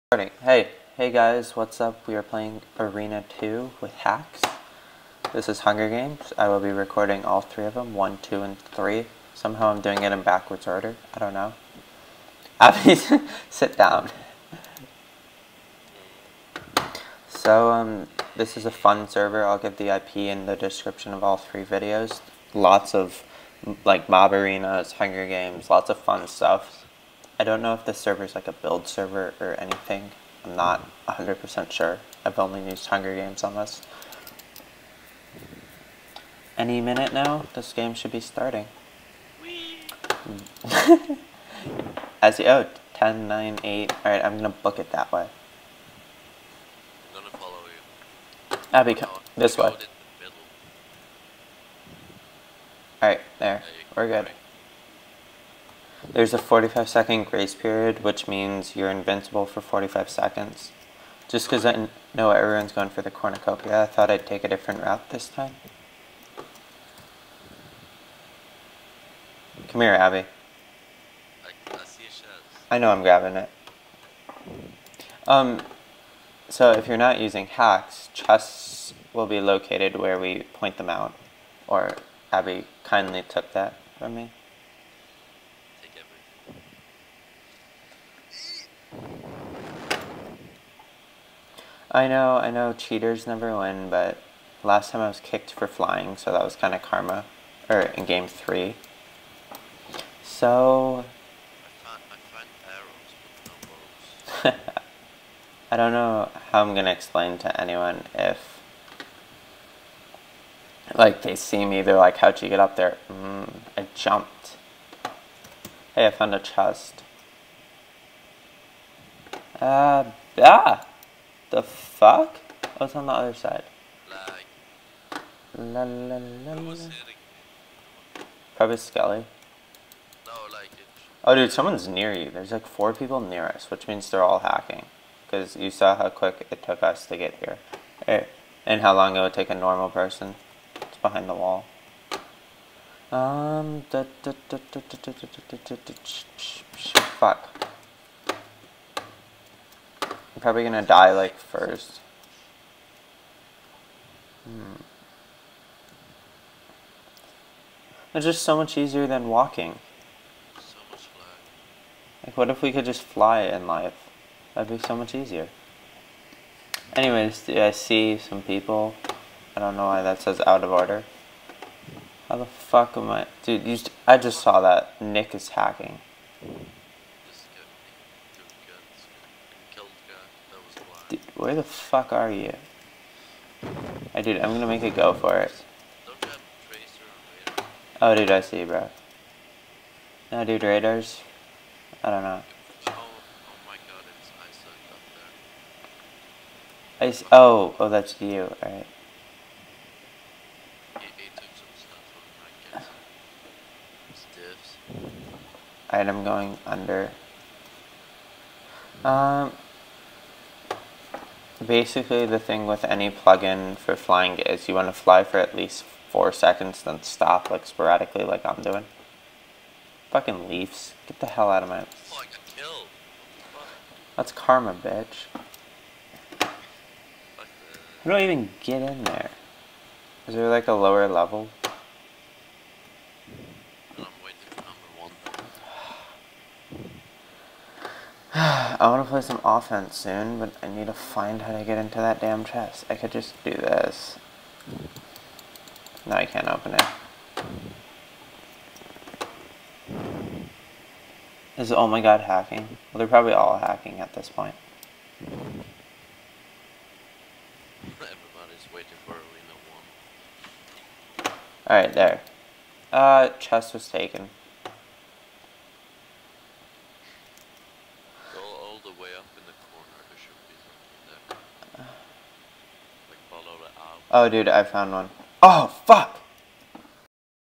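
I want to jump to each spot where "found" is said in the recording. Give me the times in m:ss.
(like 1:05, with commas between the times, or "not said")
1:56, 4:34.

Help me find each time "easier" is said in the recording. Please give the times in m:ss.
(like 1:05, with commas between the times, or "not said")
2:38, 2:45.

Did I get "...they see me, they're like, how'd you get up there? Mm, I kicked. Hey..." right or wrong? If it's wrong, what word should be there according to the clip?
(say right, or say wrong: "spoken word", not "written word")
wrong: "jumped", not "kicked".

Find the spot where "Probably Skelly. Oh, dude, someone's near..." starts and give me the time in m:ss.
2:08.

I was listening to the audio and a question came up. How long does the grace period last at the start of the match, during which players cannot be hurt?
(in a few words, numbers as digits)
45 seconds.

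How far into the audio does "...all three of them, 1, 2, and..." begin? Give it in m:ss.
0:07.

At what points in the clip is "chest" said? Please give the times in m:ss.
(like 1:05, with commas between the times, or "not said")
1:18, 1:56, 4:02, 4:23.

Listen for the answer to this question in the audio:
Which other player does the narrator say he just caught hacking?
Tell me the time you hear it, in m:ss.
2:54.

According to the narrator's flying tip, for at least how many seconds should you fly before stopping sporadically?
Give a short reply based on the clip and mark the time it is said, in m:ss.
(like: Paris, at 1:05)
4, at 3:36.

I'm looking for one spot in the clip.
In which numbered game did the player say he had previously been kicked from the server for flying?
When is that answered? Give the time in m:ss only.
1:38.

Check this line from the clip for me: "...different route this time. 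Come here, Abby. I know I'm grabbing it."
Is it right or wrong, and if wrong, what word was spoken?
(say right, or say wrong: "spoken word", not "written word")
right.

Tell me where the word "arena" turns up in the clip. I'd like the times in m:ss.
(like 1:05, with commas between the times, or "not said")
0:02, 0:24, 4:19.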